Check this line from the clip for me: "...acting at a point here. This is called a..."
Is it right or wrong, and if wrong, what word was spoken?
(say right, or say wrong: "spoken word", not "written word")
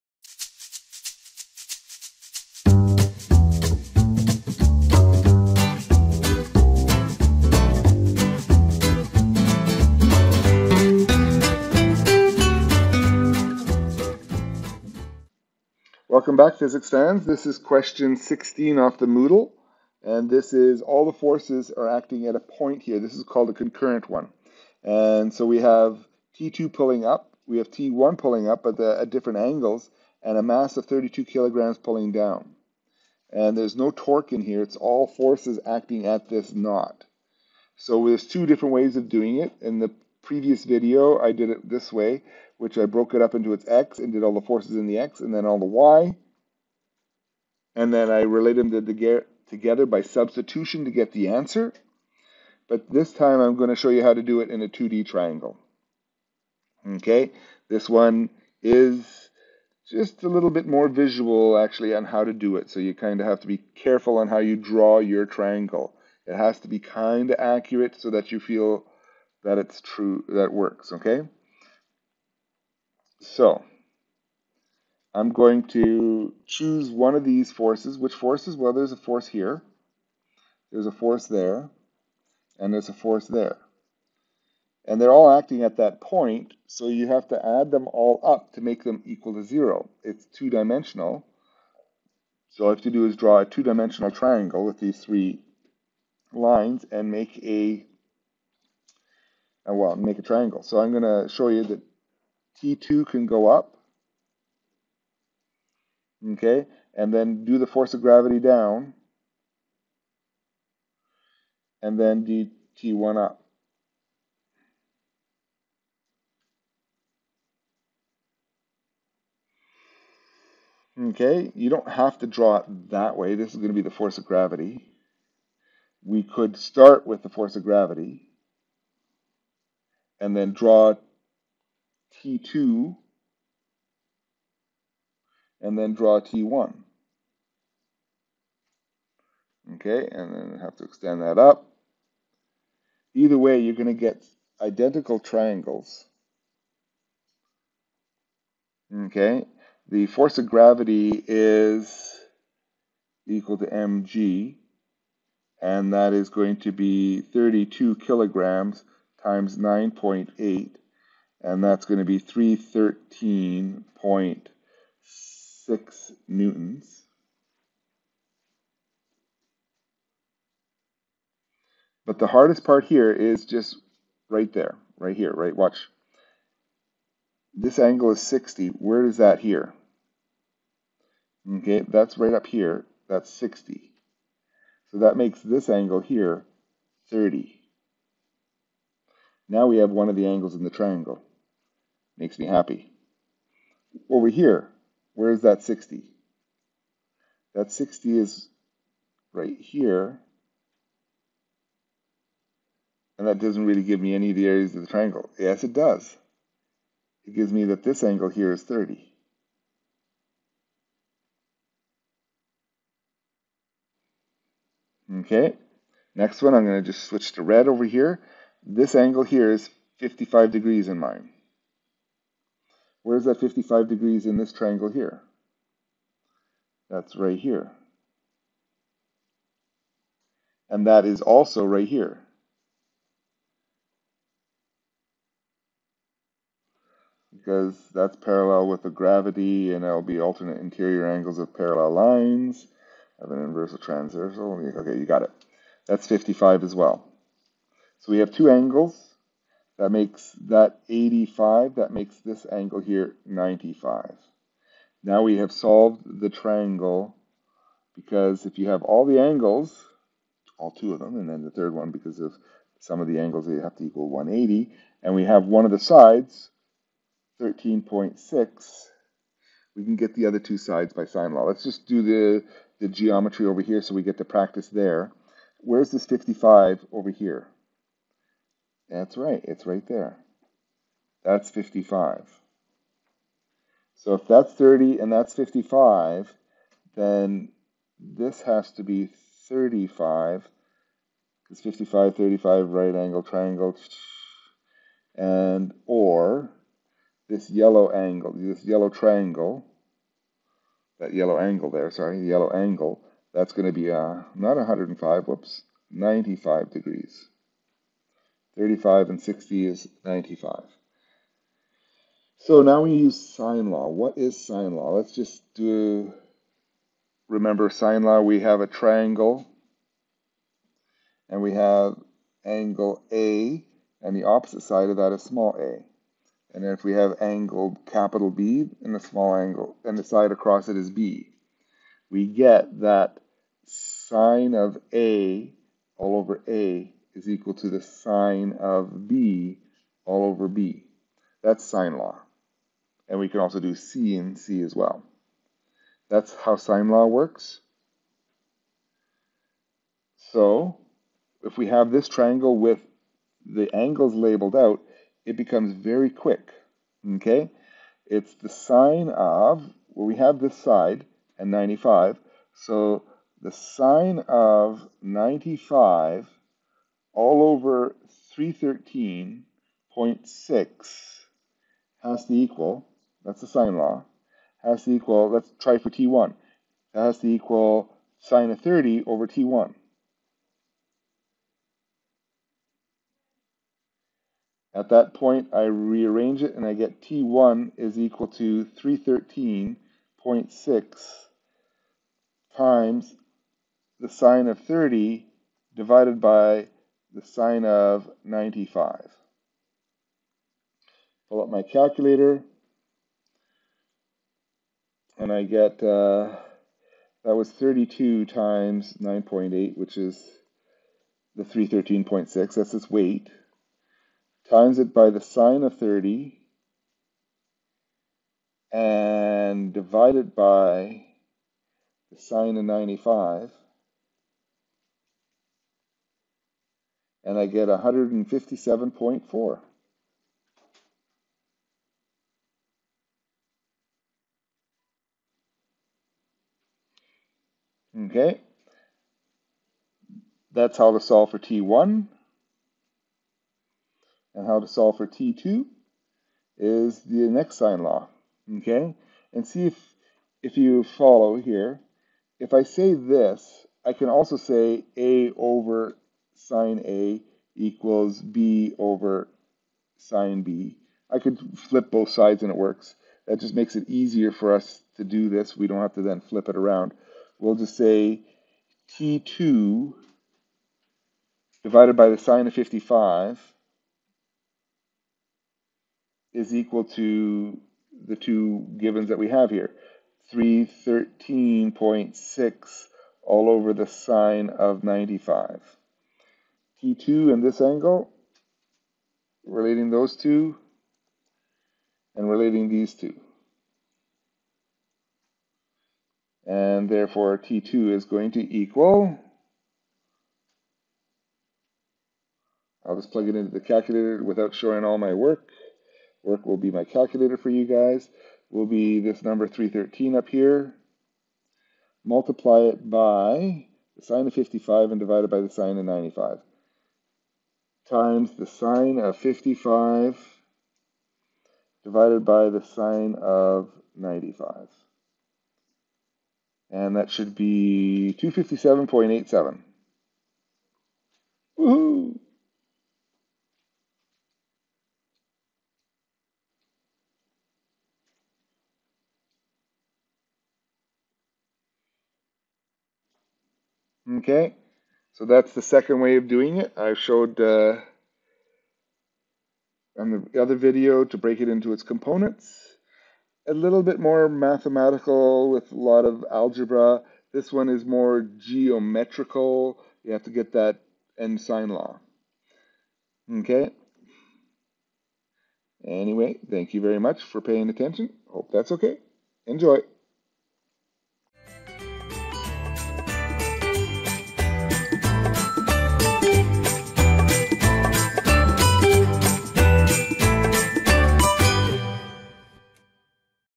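right.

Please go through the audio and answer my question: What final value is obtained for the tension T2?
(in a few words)
257.87.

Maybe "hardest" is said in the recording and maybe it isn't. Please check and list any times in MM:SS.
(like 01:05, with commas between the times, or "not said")
02:52.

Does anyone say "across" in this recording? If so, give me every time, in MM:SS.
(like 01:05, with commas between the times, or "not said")
05:30.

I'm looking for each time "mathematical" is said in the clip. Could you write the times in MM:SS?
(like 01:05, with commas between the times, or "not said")
09:14.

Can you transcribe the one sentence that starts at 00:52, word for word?
But this time I'm going to show you how to do it in a 2D triangle.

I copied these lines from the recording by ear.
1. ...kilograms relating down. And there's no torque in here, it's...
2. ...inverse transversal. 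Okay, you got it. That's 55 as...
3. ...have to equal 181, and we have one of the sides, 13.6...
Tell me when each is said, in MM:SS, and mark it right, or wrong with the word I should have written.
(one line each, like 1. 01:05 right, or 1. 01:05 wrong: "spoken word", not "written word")
1. 00:31 wrong: "pulling", not "relating"
2. 04:03 right
3. 04:23 wrong: "180", not "181".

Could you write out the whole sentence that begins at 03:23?
And that doesn't really give me any of the areas of the triangle.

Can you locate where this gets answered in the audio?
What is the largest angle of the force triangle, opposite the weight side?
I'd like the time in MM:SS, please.
05:05.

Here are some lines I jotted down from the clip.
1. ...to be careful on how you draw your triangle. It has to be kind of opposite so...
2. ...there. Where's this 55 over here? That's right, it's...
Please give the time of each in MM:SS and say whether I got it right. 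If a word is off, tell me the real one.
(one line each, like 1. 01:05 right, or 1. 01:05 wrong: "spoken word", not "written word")
1. 01:03 wrong: "accurate", not "opposite"
2. 04:34 right.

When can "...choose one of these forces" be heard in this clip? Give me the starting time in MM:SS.
01:16.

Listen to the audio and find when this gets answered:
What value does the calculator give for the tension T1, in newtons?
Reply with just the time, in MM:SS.
07:07.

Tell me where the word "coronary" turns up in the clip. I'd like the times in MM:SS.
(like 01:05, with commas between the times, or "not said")
not said.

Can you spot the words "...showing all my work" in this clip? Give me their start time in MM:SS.
08:24.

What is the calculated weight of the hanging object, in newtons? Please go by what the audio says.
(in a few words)
313.6 newtons.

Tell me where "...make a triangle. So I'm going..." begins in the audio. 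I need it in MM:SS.
01:39.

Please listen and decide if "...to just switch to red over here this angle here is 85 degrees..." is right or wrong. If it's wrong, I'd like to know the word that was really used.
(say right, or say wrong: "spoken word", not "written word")
wrong: "55", not "85".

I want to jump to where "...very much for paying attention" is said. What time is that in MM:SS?
09:26.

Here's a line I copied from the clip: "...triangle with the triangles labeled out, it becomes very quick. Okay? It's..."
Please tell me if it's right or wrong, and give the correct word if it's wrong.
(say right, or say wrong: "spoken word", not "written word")
wrong: "angles", not "triangles".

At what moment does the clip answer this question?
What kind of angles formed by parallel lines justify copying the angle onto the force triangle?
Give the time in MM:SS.
04:00.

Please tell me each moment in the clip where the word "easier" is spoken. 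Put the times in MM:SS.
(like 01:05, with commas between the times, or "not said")
07:43.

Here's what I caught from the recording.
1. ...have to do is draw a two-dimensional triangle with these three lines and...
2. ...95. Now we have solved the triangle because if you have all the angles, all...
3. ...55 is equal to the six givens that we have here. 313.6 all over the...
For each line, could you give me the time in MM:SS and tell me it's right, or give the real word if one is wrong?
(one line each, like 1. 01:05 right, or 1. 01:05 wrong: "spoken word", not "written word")
1. 01:32 right
2. 04:13 right
3. 07:52 wrong: "two", not "six".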